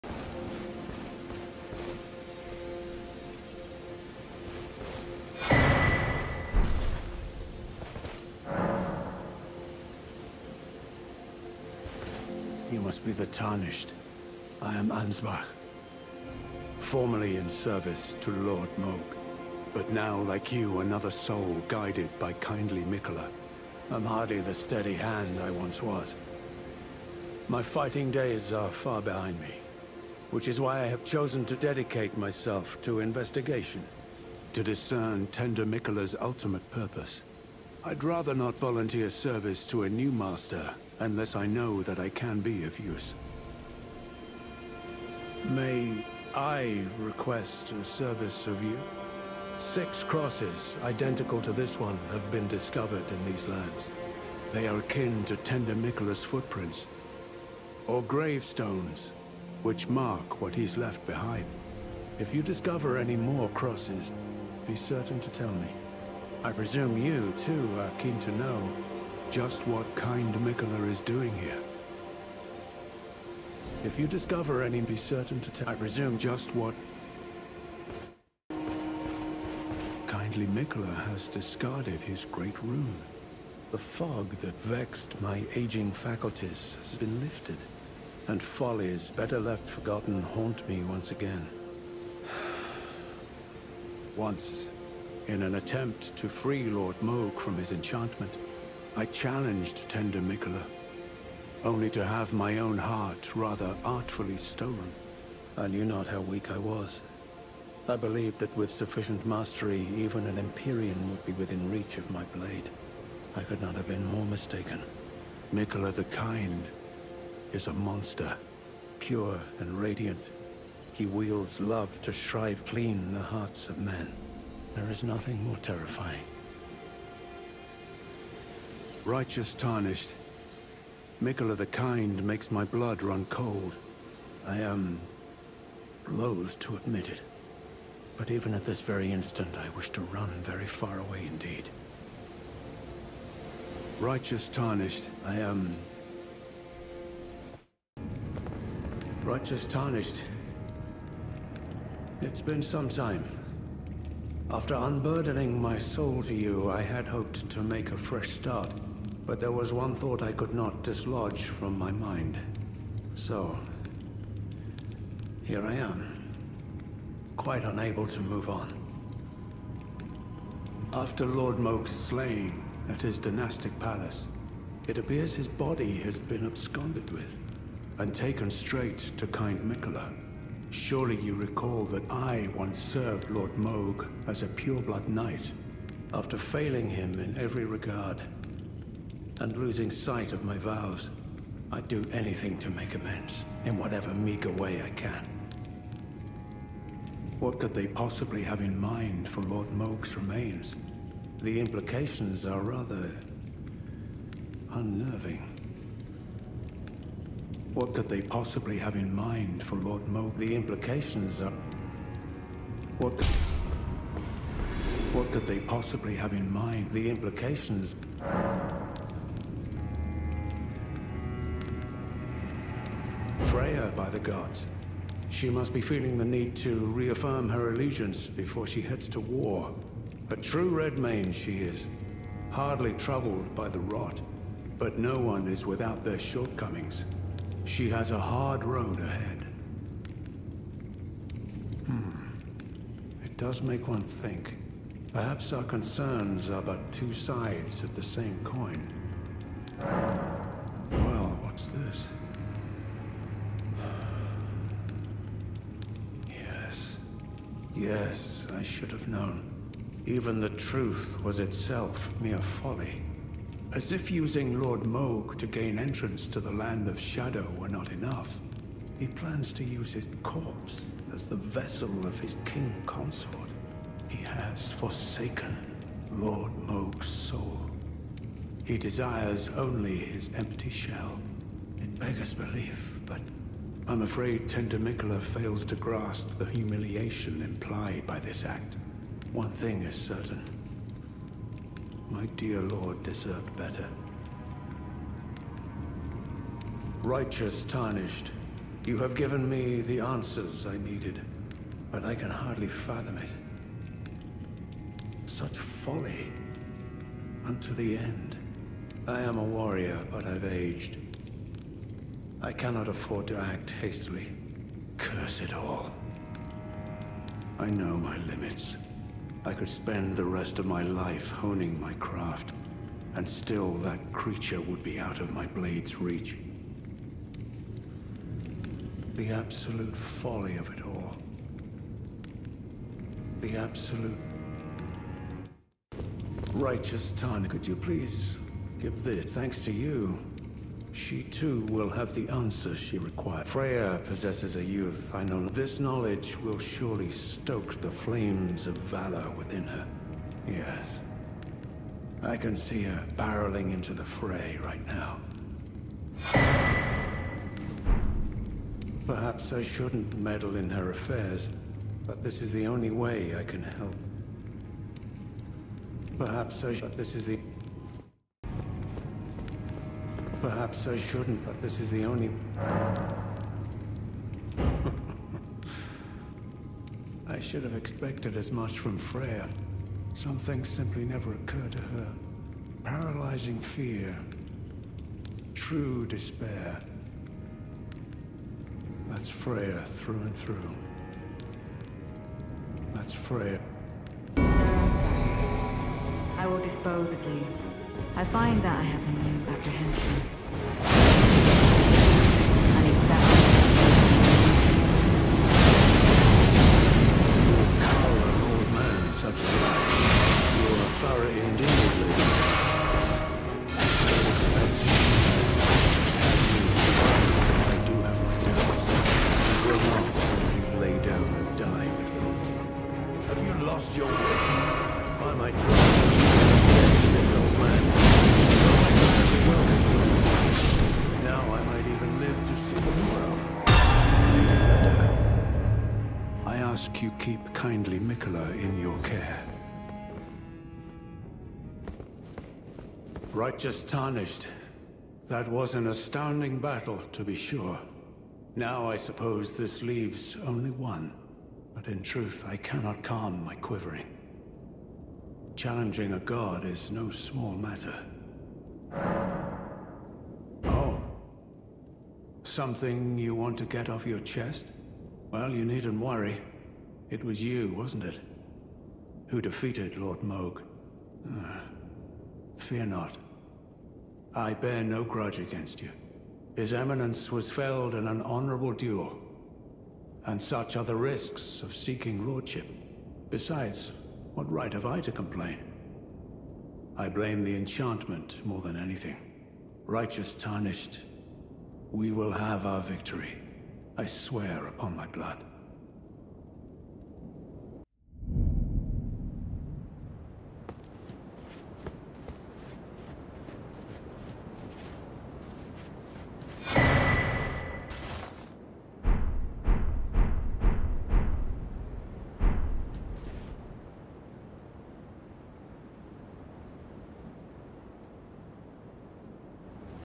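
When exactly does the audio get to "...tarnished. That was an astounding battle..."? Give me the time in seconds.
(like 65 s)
443 s.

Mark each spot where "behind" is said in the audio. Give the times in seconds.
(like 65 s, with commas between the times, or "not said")
29 s, 61 s.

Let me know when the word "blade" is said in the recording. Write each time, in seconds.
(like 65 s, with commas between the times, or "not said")
112 s, 325 s.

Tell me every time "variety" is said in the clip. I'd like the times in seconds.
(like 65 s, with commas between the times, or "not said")
not said.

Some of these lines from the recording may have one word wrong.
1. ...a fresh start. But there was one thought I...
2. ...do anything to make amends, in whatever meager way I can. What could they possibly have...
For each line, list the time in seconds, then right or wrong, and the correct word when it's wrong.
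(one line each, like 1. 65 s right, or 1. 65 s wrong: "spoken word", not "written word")
1. 157 s right
2. 191 s right.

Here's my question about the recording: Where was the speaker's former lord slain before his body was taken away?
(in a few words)
his dynastic palace.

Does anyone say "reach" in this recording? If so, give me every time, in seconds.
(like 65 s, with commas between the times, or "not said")
111 s, 325 s.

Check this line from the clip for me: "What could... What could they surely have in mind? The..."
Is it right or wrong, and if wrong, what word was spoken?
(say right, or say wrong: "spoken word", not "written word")
wrong: "possibly", not "surely".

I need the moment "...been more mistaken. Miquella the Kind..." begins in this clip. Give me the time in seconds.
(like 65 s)
113 s.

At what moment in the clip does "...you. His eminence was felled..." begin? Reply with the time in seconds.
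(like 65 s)
475 s.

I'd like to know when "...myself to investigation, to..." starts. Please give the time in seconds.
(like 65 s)
32 s.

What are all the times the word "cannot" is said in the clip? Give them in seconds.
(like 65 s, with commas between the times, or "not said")
312 s, 452 s.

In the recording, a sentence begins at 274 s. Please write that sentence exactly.
He has forsaken Lord Mohg's soul.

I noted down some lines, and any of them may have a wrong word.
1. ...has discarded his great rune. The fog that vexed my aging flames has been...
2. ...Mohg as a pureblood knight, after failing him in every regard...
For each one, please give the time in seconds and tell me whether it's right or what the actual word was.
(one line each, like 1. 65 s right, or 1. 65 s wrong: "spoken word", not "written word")
1. 81 s wrong: "faculties", not "flames"
2. 183 s right.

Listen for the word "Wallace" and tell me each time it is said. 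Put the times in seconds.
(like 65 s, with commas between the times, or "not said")
not said.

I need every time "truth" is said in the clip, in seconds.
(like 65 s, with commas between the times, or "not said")
260 s, 452 s.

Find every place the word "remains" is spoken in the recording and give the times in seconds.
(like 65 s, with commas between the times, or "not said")
200 s.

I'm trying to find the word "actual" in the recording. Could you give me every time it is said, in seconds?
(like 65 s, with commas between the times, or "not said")
not said.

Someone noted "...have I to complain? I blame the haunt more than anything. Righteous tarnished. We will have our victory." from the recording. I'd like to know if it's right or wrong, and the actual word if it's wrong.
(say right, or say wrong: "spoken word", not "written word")
wrong: "enchantment", not "haunt".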